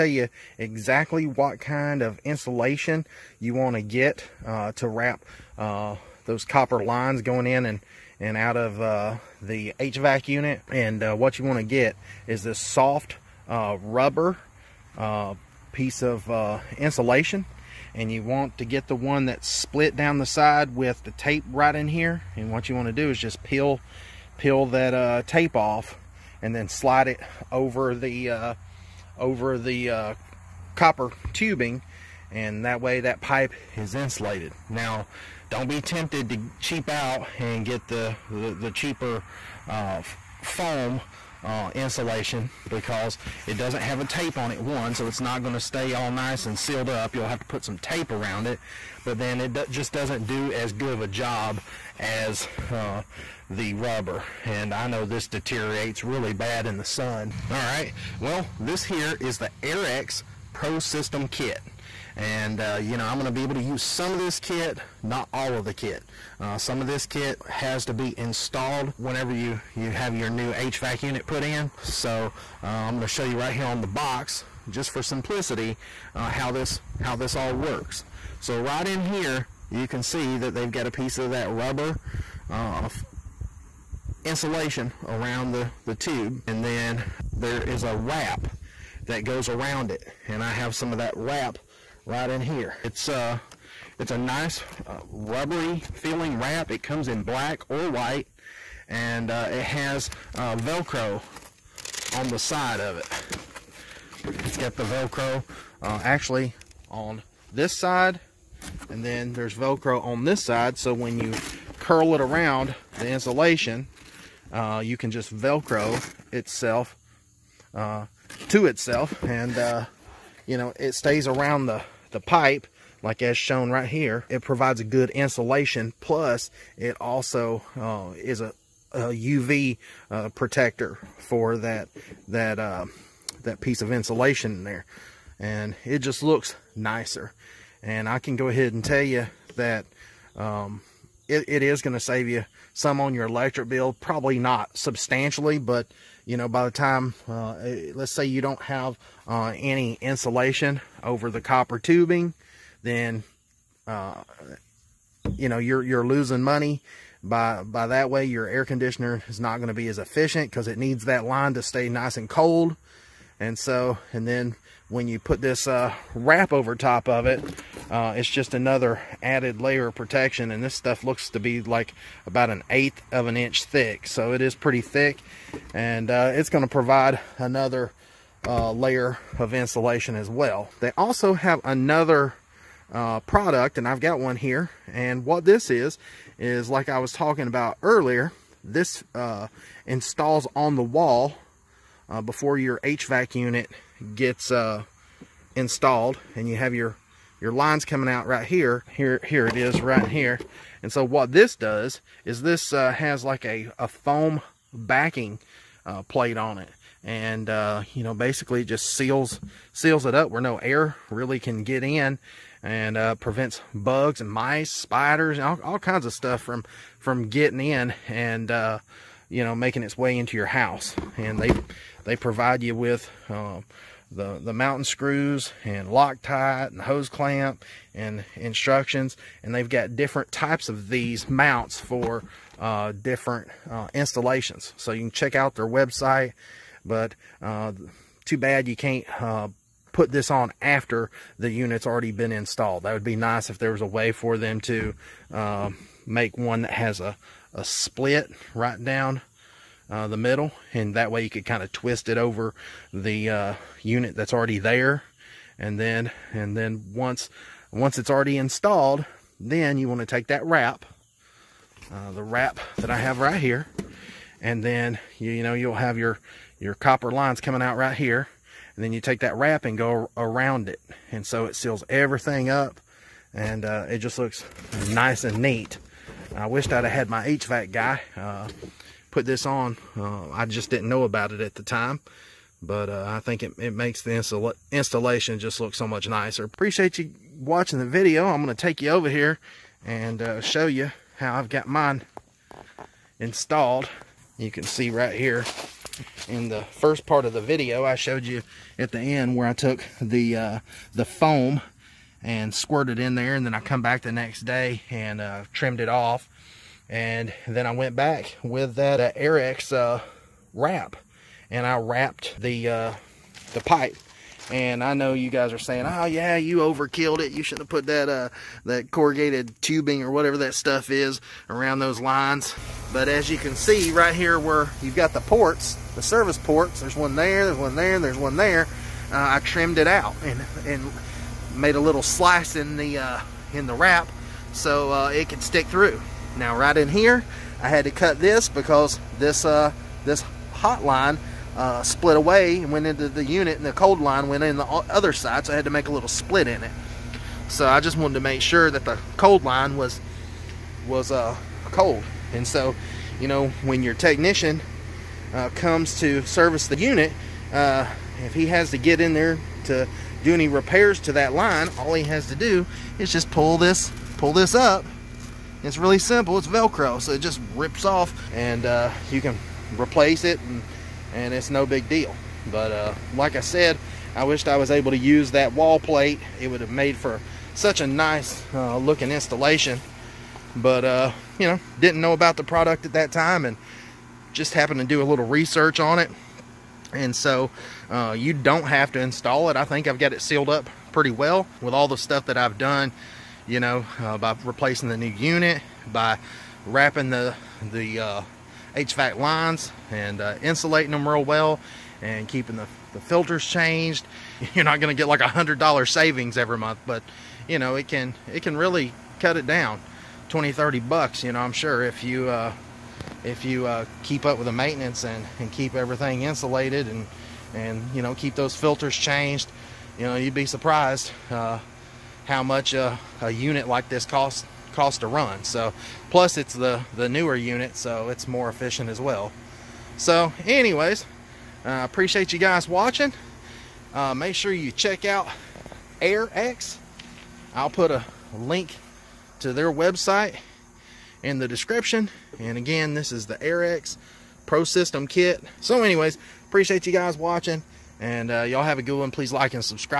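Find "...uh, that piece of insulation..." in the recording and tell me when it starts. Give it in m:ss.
2:12.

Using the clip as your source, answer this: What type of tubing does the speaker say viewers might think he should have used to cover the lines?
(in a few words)
Corrugated tubing.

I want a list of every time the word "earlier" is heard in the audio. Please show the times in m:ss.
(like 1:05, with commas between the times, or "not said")
3:07.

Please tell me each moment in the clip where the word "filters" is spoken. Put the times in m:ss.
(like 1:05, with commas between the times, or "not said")
6:43, 6:58.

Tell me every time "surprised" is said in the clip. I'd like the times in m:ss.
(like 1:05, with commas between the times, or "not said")
7:00.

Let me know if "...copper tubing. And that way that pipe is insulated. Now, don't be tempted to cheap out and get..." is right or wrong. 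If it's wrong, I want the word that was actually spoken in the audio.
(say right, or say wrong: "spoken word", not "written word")
right.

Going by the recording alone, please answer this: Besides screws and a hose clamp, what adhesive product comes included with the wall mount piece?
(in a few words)
Loctite.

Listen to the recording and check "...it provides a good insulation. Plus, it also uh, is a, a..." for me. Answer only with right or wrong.
right.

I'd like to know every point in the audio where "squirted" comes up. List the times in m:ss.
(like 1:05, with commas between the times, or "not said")
5:02.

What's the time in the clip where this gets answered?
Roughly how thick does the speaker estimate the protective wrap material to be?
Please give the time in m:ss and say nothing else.
2:52.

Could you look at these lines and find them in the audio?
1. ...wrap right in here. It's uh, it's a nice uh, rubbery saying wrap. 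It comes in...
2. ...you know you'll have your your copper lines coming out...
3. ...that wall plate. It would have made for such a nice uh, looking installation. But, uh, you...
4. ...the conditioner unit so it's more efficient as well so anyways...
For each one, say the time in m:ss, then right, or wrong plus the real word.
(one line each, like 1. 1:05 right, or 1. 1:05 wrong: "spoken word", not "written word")
1. 1:31 wrong: "feeling", not "saying"
2. 4:25 right
3. 6:15 right
4. 7:06 wrong: "newer", not "conditioner".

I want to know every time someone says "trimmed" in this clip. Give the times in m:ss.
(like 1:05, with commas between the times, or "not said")
5:05, 5:29.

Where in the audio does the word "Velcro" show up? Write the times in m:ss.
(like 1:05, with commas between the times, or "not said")
1:40, 1:44, 1:49, 1:55, 6:06.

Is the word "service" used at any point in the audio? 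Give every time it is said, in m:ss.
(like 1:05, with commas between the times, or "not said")
5:26, 5:56.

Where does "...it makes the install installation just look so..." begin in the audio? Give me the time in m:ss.
4:43.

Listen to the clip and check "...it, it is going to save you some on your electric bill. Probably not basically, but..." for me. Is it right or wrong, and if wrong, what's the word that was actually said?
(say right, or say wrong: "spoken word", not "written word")
wrong: "substantially", not "basically".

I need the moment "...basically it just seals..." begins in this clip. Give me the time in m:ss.
3:28.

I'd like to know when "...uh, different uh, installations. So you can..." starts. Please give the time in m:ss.
3:52.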